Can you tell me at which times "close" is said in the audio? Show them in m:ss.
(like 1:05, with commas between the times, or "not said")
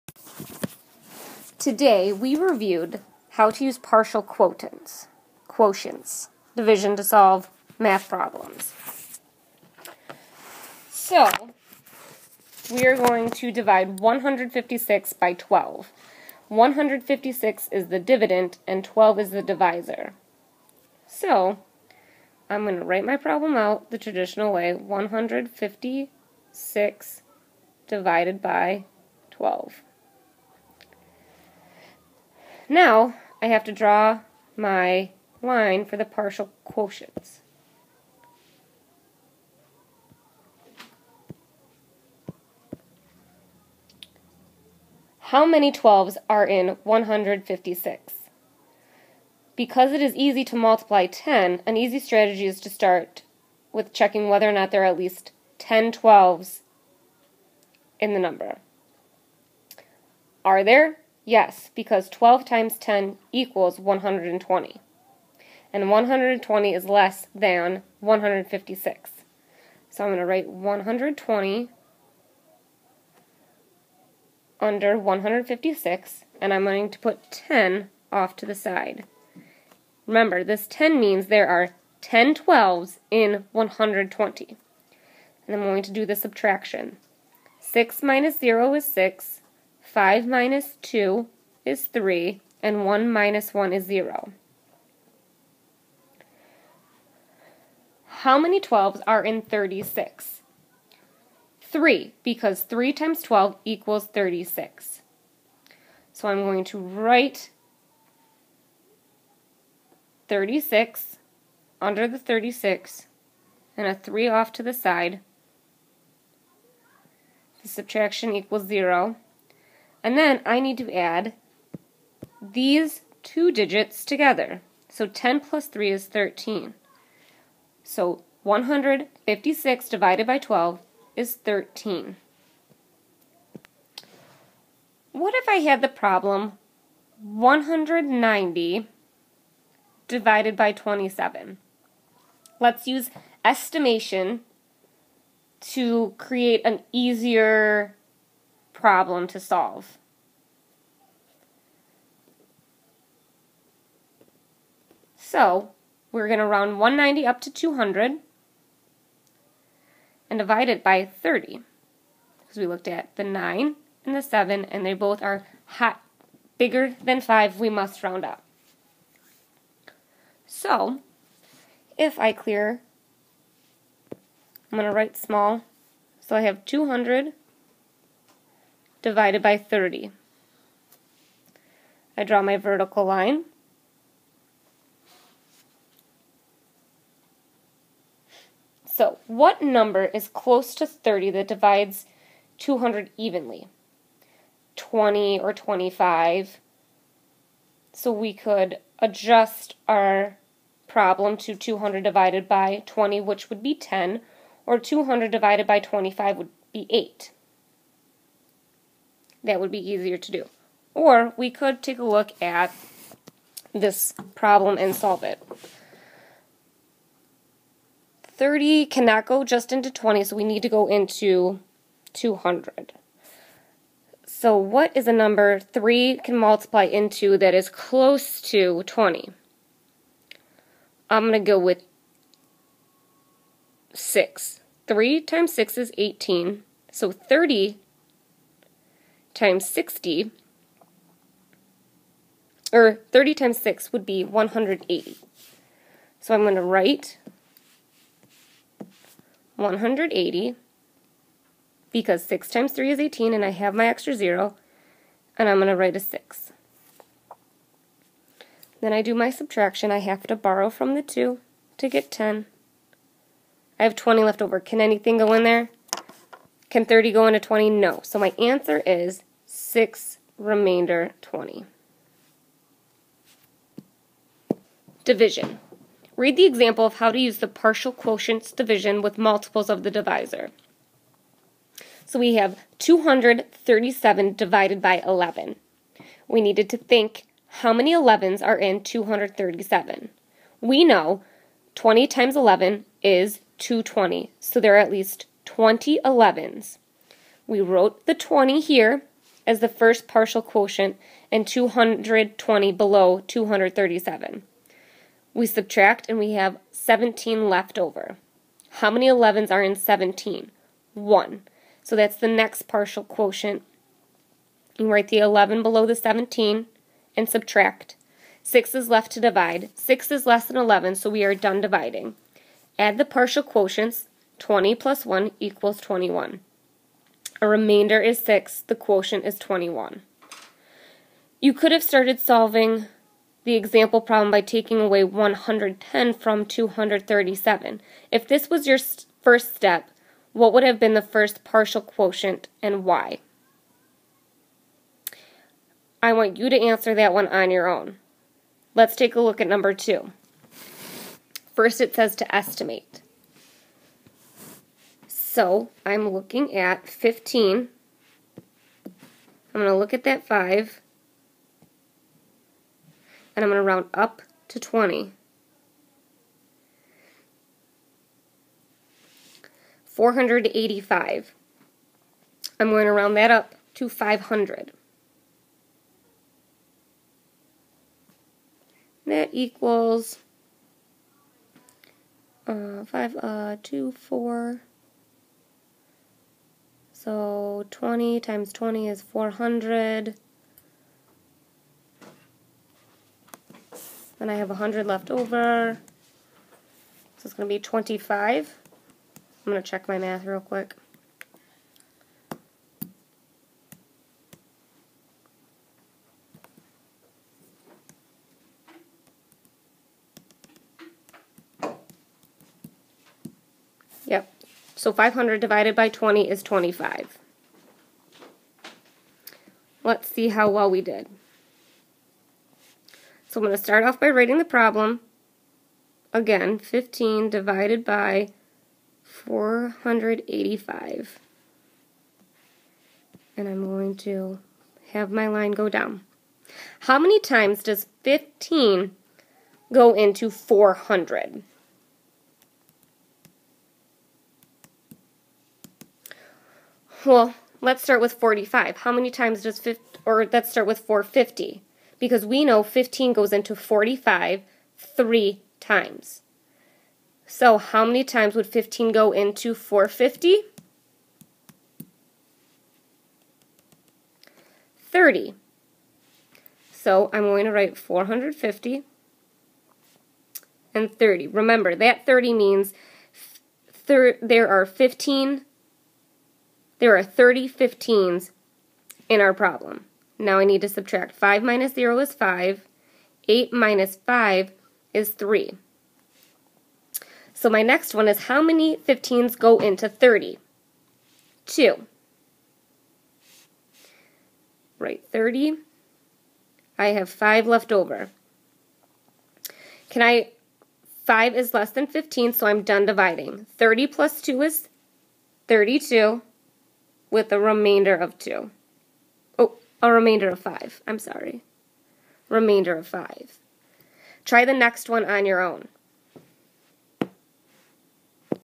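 3:10, 3:47.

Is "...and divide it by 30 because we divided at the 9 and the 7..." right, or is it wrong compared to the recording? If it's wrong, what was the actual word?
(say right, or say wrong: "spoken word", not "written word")
wrong: "looked", not "divided".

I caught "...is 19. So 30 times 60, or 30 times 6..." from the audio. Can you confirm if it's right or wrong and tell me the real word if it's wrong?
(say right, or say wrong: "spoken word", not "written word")
wrong: "18", not "19".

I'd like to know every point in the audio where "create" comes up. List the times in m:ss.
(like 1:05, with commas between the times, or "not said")
2:26.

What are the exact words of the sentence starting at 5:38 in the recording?
If this was your first step, what would have been the first partial quotient and why?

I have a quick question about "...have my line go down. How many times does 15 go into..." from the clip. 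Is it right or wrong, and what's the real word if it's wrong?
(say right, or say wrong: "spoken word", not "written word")
right.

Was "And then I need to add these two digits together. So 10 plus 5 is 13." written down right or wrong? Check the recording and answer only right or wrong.
wrong.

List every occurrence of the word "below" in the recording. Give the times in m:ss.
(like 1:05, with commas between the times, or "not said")
5:02, 5:15.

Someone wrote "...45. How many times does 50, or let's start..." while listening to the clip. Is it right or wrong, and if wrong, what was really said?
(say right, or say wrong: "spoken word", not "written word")
right.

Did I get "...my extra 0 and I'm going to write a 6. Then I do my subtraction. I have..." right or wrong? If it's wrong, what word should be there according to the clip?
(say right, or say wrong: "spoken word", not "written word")
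right.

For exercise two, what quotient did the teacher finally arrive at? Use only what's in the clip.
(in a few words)
32.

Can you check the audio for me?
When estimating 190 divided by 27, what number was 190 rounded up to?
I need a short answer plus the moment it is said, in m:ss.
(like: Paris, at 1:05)
200, at 2:36.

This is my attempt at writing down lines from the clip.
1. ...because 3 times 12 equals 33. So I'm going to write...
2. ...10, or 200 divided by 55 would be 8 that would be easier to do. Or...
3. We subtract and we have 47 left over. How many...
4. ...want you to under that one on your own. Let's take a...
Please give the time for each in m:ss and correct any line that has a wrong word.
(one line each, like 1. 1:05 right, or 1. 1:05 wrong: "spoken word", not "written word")
1. 1:42 wrong: "36", not "33"
2. 3:23 wrong: "25", not "55"
3. 5:05 wrong: "17", not "47"
4. 5:46 wrong: "answer", not "under".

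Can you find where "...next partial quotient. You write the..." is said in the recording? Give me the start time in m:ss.
5:12.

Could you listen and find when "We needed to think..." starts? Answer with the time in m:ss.
4:46.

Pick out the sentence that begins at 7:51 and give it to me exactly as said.
Remember, that 30 means there are 15 there are 30 15s in our problem.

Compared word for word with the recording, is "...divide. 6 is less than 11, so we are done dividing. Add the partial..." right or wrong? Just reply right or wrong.
right.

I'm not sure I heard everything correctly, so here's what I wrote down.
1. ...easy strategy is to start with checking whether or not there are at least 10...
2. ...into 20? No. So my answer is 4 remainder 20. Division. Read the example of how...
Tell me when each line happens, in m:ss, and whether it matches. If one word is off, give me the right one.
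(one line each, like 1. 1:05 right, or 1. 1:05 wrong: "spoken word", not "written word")
1. 0:51 right
2. 4:27 wrong: "6", not "4".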